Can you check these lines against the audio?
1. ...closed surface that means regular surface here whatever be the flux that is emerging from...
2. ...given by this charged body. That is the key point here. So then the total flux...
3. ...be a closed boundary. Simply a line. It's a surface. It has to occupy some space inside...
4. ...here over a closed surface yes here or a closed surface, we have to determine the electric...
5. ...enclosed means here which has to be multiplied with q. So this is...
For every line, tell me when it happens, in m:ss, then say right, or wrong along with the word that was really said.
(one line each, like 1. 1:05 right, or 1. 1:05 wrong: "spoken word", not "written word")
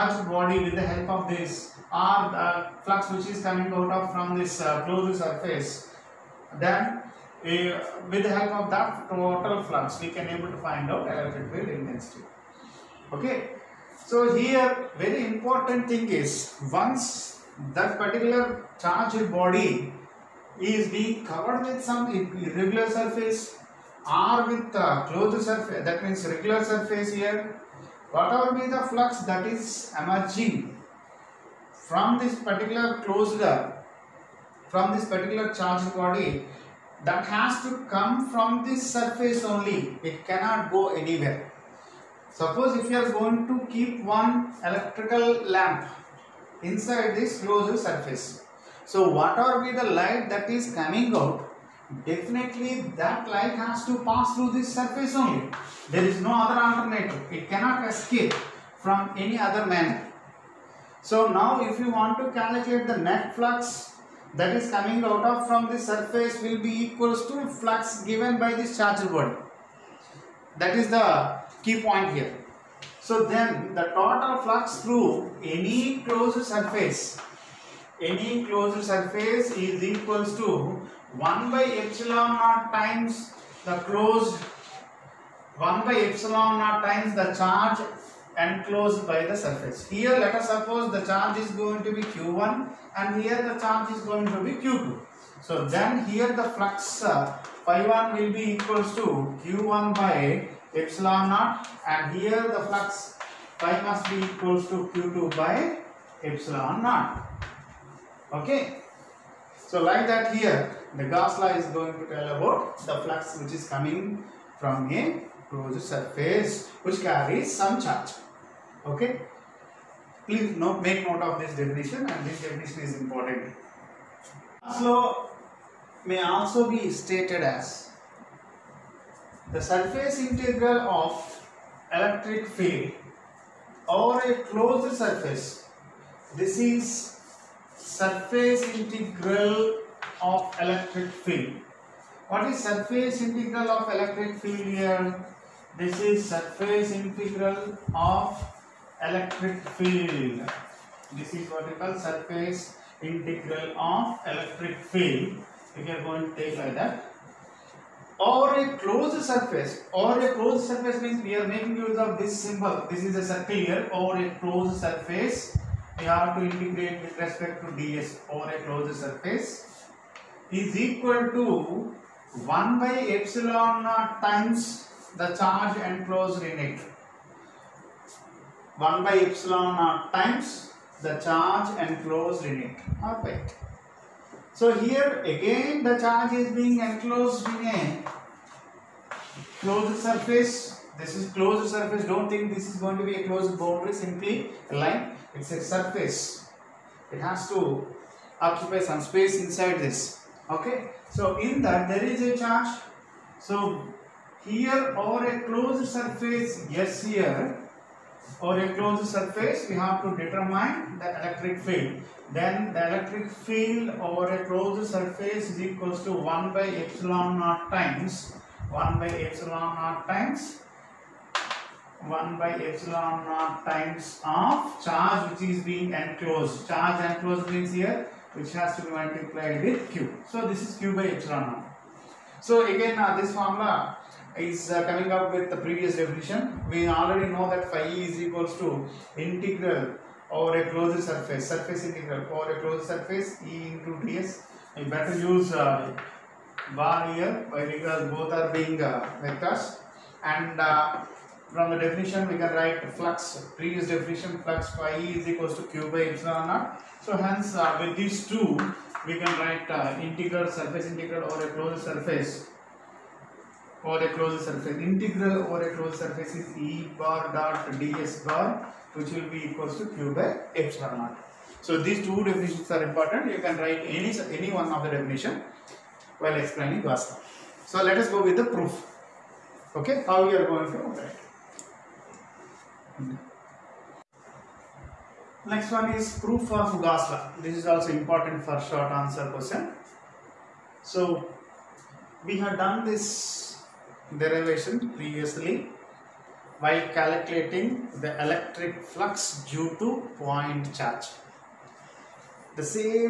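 1. 0:25 right
2. 1:08 right
3. 3:13 right
4. 3:24 right
5. 3:47 right.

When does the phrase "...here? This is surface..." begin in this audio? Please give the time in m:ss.
2:24.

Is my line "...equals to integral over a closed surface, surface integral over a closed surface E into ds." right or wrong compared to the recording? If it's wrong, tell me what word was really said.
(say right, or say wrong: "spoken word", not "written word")
right.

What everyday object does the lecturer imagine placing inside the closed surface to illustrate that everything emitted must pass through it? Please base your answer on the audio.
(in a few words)
Electrical lamp.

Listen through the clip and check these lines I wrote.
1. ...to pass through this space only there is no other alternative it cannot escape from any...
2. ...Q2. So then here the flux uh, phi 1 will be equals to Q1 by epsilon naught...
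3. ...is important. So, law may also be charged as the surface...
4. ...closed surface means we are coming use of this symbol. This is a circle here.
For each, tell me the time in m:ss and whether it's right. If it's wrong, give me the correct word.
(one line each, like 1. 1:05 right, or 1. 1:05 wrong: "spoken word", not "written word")
1. 0:53 wrong: "surface", not "space"
2. 1:34 right
3. 2:02 wrong: "stated", not "charged"
4. 2:40 wrong: "making", not "coming".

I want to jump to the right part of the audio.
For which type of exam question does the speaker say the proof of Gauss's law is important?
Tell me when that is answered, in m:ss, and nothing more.
4:48.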